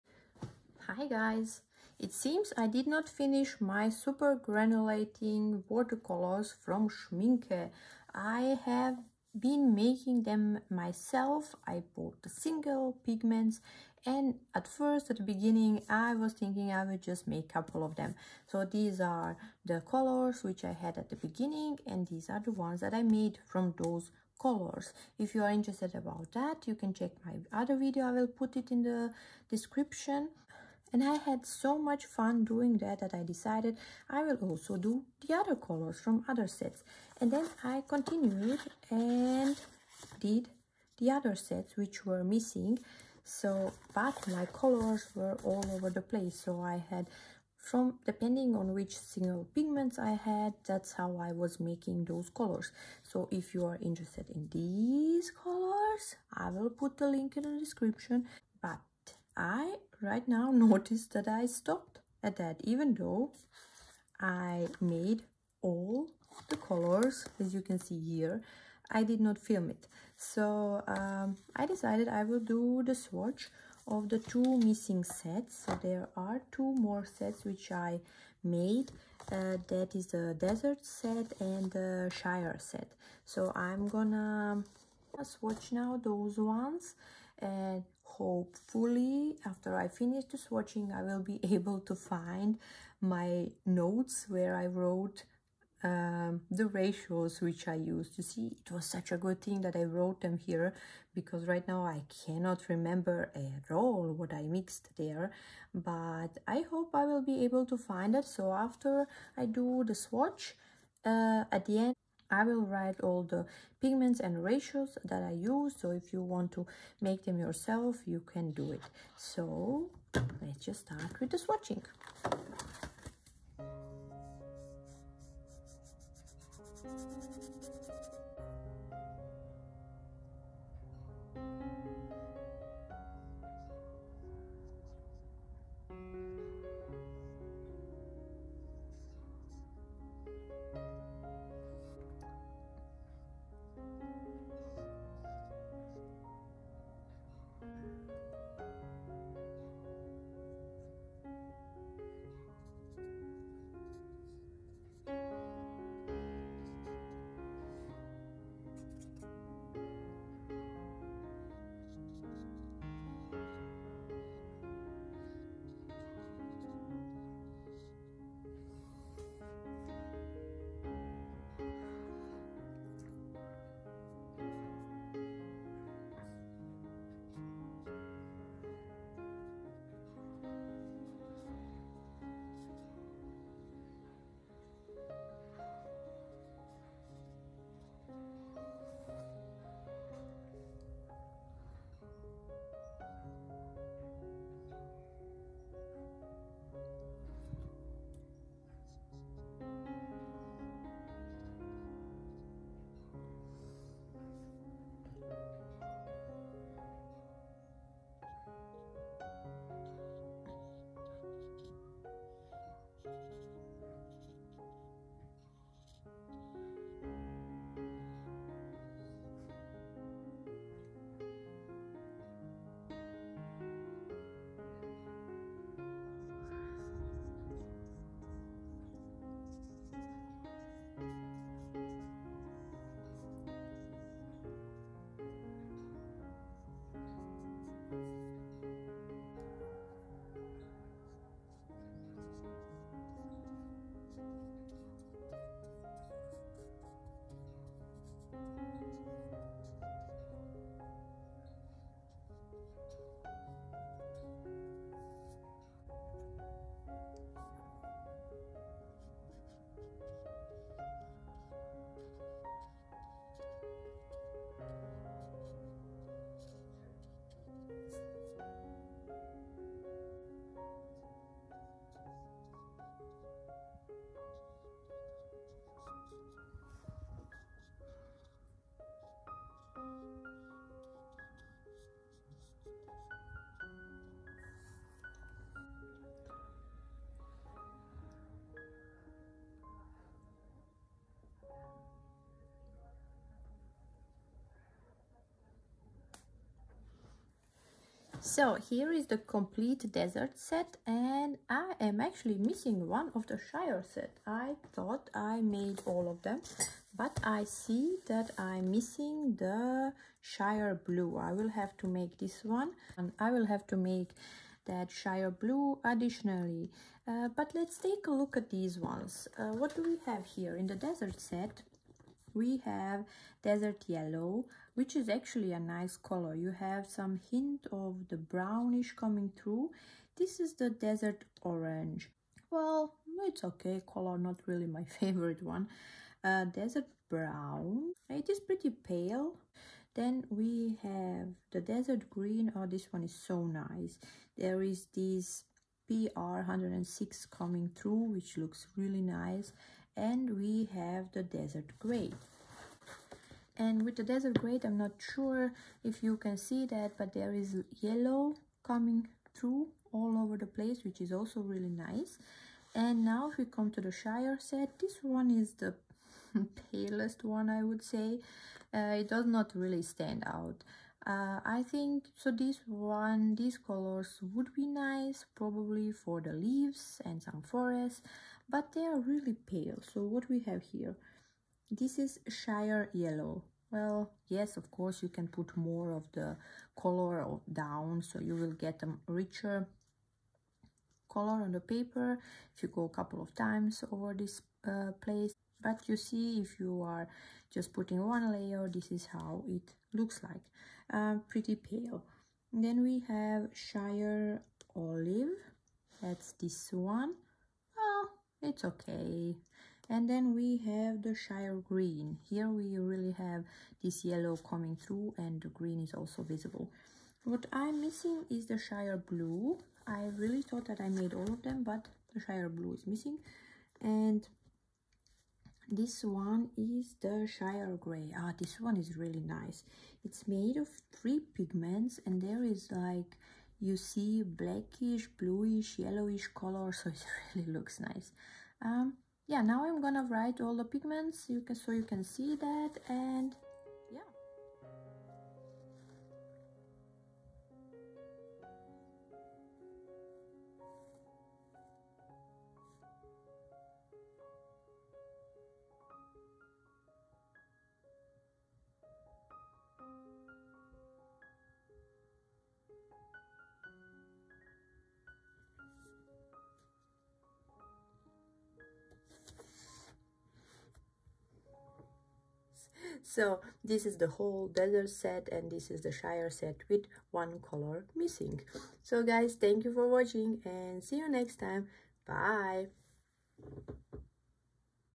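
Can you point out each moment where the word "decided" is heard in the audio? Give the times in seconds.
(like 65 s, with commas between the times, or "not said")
33 s, 71 s.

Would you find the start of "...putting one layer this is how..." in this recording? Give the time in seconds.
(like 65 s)
397 s.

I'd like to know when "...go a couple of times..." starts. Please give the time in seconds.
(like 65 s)
392 s.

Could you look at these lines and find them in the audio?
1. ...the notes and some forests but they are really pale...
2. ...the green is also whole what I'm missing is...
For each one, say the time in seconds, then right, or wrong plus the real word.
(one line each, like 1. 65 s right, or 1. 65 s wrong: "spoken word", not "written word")
1. 376 s wrong: "leaves", not "notes"
2. 415 s wrong: "visible", not "whole".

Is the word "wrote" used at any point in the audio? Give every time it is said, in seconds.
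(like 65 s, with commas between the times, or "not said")
94 s, 99 s.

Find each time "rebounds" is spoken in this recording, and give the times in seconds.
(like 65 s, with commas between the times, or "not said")
not said.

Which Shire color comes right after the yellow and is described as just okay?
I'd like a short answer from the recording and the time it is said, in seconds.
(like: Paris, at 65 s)
Shire Olive, at 403 s.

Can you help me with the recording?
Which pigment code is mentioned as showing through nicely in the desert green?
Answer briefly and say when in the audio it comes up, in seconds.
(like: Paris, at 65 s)
BR106, at 345 s.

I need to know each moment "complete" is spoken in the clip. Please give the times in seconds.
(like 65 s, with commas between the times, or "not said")
299 s.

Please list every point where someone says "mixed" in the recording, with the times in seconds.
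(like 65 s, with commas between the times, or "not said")
104 s.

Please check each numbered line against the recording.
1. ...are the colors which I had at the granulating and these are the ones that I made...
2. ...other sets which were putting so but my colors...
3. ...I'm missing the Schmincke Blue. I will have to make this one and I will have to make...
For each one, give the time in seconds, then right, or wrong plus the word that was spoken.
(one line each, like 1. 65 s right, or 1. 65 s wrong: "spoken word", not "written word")
1. 19 s wrong: "beginning", not "granulating"
2. 41 s wrong: "missing", not "putting"
3. 308 s wrong: "Shire", not "Schmincke".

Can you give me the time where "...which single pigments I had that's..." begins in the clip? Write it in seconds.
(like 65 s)
48 s.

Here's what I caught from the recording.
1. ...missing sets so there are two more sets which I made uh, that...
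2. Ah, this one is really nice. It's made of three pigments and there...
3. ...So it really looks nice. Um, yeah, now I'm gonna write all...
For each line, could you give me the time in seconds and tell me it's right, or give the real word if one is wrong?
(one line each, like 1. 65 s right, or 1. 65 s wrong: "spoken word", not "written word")
1. 74 s right
2. 428 s right
3. 436 s right.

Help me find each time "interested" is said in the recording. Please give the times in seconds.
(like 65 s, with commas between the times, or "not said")
25 s, 53 s.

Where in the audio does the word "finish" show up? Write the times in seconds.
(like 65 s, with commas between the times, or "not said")
3 s, 89 s.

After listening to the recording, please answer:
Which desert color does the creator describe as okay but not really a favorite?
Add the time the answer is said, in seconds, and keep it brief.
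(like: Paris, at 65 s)
desert orange, at 330 s.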